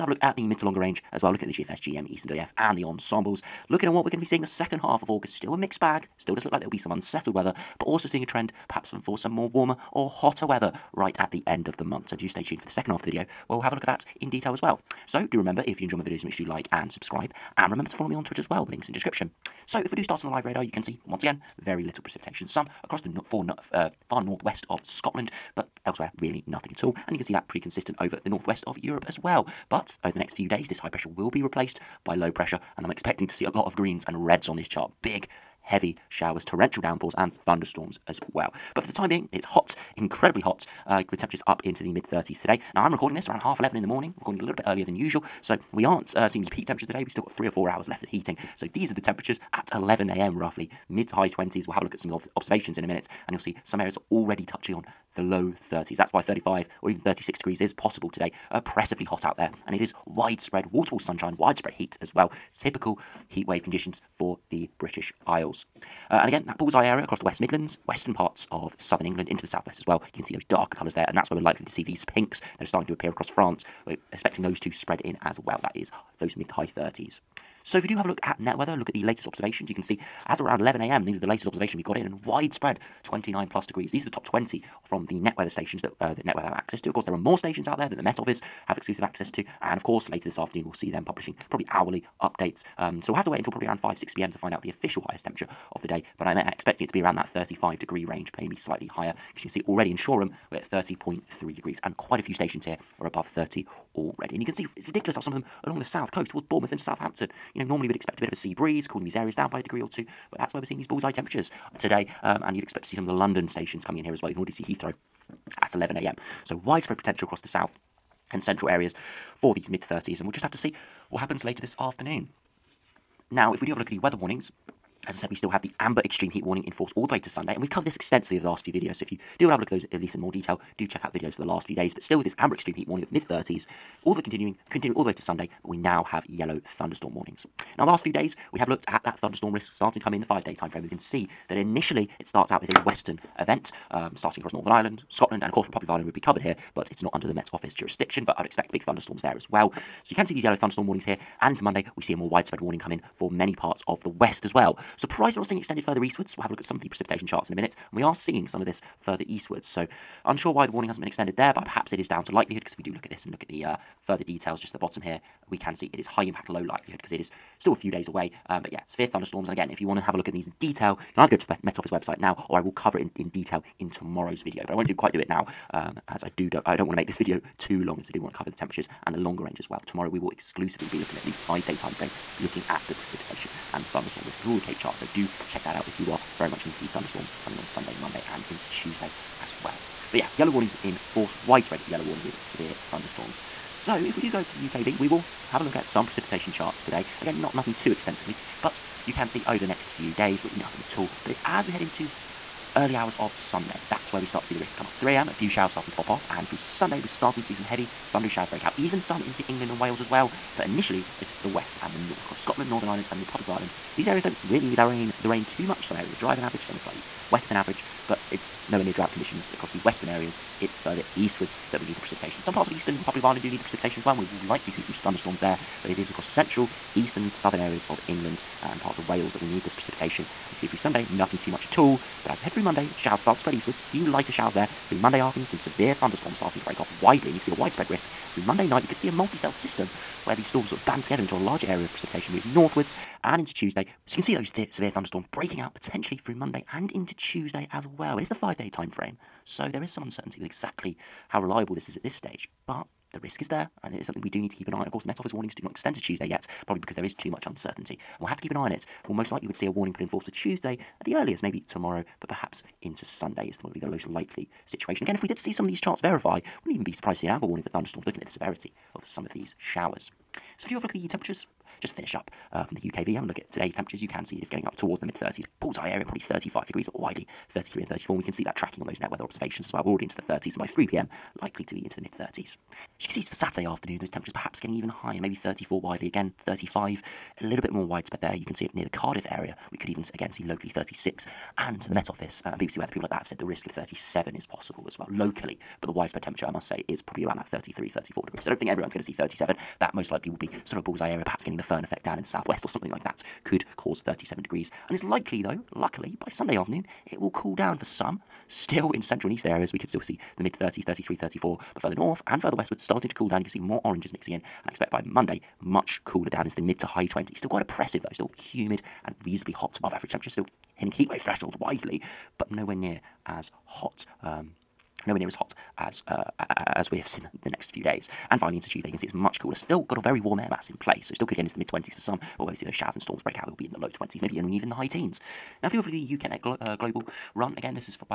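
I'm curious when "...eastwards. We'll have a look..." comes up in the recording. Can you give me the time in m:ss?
2:36.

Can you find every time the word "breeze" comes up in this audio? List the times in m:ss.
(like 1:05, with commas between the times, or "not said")
1:48.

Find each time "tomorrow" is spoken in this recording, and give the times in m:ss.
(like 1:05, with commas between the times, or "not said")
2:53, 2:59, 4:21.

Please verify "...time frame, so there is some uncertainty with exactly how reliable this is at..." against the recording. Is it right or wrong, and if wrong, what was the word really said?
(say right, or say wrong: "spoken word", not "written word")
right.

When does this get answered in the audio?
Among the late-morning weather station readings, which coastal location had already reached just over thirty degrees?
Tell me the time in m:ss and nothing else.
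1:39.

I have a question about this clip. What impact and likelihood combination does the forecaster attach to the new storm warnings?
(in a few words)
High impact, low likelihood.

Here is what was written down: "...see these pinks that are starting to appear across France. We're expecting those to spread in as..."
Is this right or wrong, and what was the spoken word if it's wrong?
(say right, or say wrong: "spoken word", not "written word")
right.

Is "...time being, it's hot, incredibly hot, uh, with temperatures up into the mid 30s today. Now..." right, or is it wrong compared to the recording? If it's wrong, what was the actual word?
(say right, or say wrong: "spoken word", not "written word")
right.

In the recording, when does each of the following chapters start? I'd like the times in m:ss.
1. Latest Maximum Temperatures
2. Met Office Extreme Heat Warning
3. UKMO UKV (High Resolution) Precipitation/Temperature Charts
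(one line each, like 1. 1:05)
1. 1:17
2. 2:03
3. 3:13.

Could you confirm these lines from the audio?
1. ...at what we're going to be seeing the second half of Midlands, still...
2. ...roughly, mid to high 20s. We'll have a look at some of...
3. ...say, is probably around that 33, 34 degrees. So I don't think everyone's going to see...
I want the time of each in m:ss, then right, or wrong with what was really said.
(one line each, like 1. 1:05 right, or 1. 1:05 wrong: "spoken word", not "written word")
1. 0:03 wrong: "August", not "Midlands"
2. 0:50 right
3. 4:56 right.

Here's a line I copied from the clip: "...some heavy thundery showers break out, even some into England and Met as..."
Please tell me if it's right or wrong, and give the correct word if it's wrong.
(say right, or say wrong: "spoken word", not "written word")
wrong: "Wales", not "Met".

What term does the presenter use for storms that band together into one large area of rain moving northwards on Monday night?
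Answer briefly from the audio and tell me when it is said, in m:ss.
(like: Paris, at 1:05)
Multi-celled system, at 3:59.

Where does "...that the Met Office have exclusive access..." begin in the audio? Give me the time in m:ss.
1:27.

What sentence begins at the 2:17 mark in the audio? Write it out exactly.
Now, last few days, we have looked at that thunderstorm risk starting to come in the five-day time frame.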